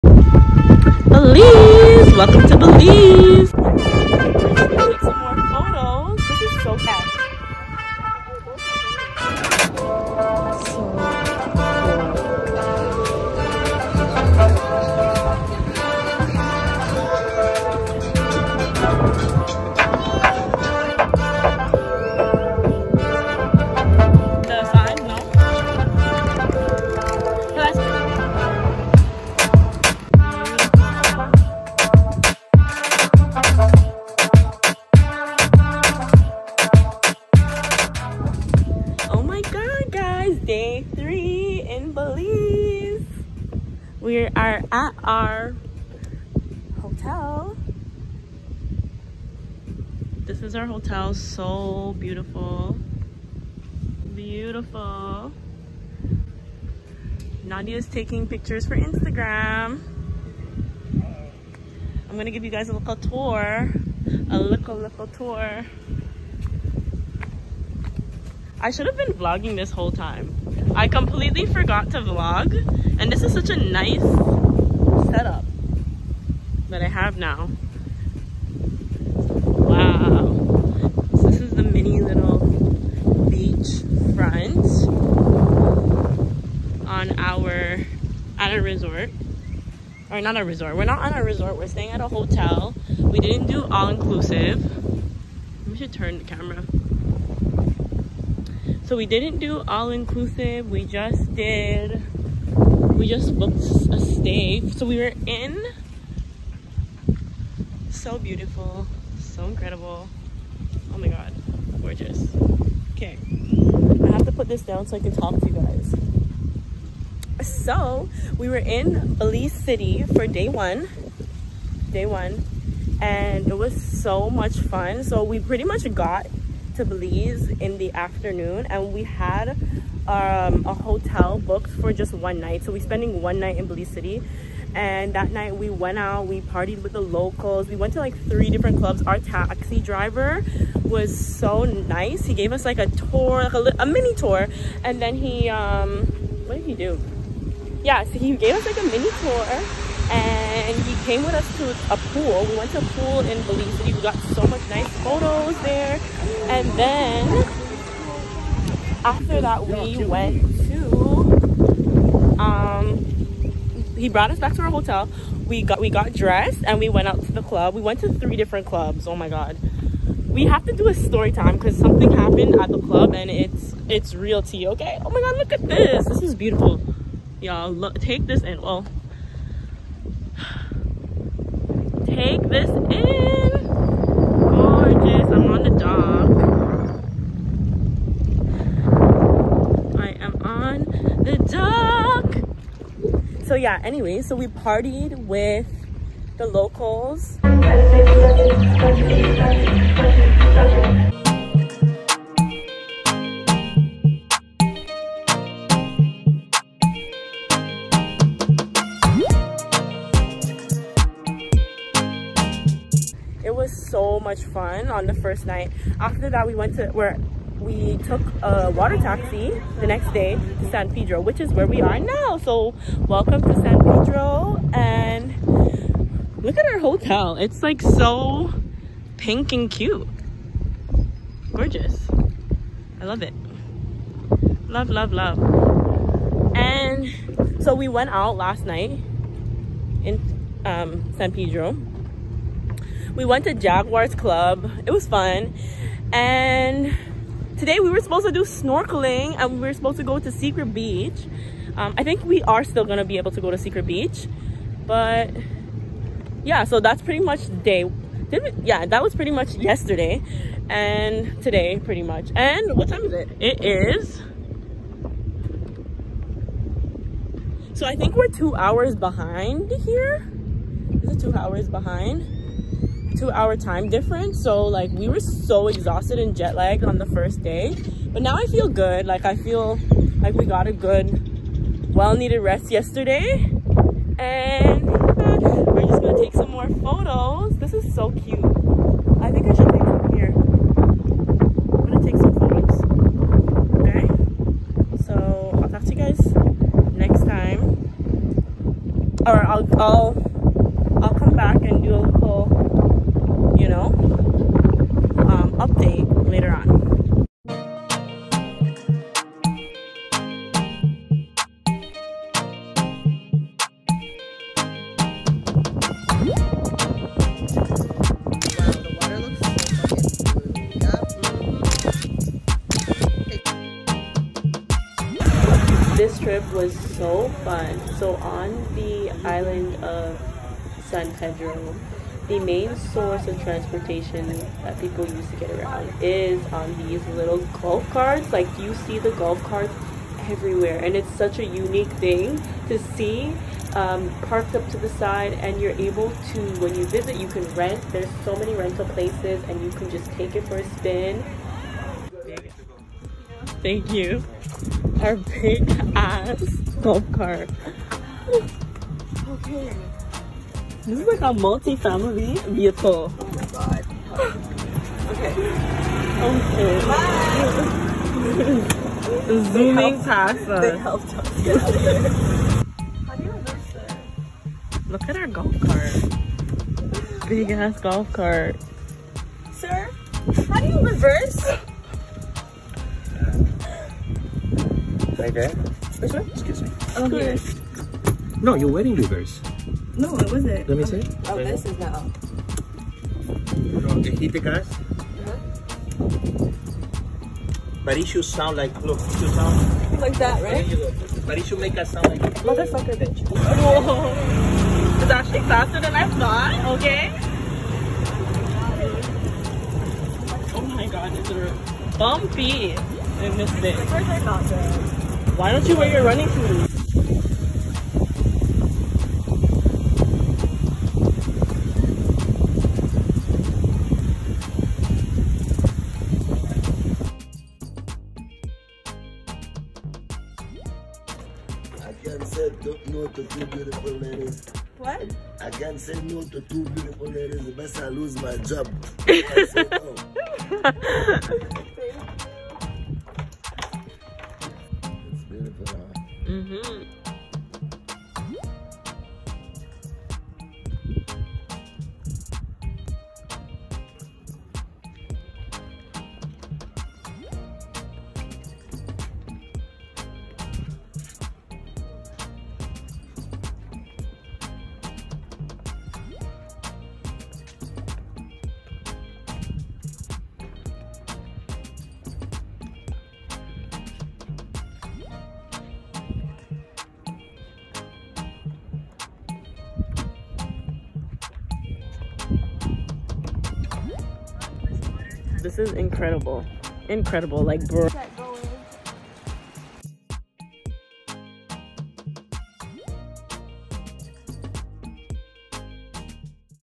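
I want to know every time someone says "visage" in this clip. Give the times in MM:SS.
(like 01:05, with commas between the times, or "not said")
not said.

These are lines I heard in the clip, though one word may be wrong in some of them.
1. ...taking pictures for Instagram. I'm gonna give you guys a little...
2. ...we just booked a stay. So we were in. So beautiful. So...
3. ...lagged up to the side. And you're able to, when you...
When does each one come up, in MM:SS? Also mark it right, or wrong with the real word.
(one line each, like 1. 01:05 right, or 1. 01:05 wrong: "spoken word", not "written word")
1. 00:57 right
2. 01:42 right
3. 05:44 wrong: "parked", not "lagged".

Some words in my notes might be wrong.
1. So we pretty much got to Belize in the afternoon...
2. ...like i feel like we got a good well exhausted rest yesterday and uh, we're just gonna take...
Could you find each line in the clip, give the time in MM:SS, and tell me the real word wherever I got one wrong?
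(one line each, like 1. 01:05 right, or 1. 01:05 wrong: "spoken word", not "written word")
1. 02:05 right
2. 04:39 wrong: "needed", not "exhausted".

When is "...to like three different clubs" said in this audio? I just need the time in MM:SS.
02:17.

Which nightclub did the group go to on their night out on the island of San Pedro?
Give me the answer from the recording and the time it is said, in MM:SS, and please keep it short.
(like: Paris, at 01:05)
Jaguars Club, at 04:03.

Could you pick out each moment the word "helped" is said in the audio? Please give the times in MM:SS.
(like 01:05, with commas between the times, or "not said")
06:10.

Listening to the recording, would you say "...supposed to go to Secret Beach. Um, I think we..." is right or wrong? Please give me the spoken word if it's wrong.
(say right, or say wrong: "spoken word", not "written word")
right.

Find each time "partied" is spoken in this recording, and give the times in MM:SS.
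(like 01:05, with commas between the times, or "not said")
02:16, 03:14.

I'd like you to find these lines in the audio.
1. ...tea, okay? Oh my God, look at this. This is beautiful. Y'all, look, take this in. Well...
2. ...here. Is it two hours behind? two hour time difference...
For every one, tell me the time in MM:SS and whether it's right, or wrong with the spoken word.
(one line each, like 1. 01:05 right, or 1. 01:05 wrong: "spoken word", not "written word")
1. 02:54 right
2. 04:29 right.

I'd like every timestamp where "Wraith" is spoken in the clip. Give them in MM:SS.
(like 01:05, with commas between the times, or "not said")
not said.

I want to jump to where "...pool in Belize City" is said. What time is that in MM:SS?
02:32.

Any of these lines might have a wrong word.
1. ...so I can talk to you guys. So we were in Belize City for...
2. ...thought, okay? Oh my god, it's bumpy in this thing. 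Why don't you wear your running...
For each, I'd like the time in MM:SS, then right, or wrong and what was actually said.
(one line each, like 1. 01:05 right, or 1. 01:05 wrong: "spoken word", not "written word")
1. 01:54 right
2. 06:46 right.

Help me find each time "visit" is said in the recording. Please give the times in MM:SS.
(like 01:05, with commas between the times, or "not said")
05:46.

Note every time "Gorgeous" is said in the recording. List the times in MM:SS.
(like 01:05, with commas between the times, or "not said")
01:51, 03:51.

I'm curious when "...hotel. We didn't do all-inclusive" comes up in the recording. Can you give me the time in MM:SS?
01:32.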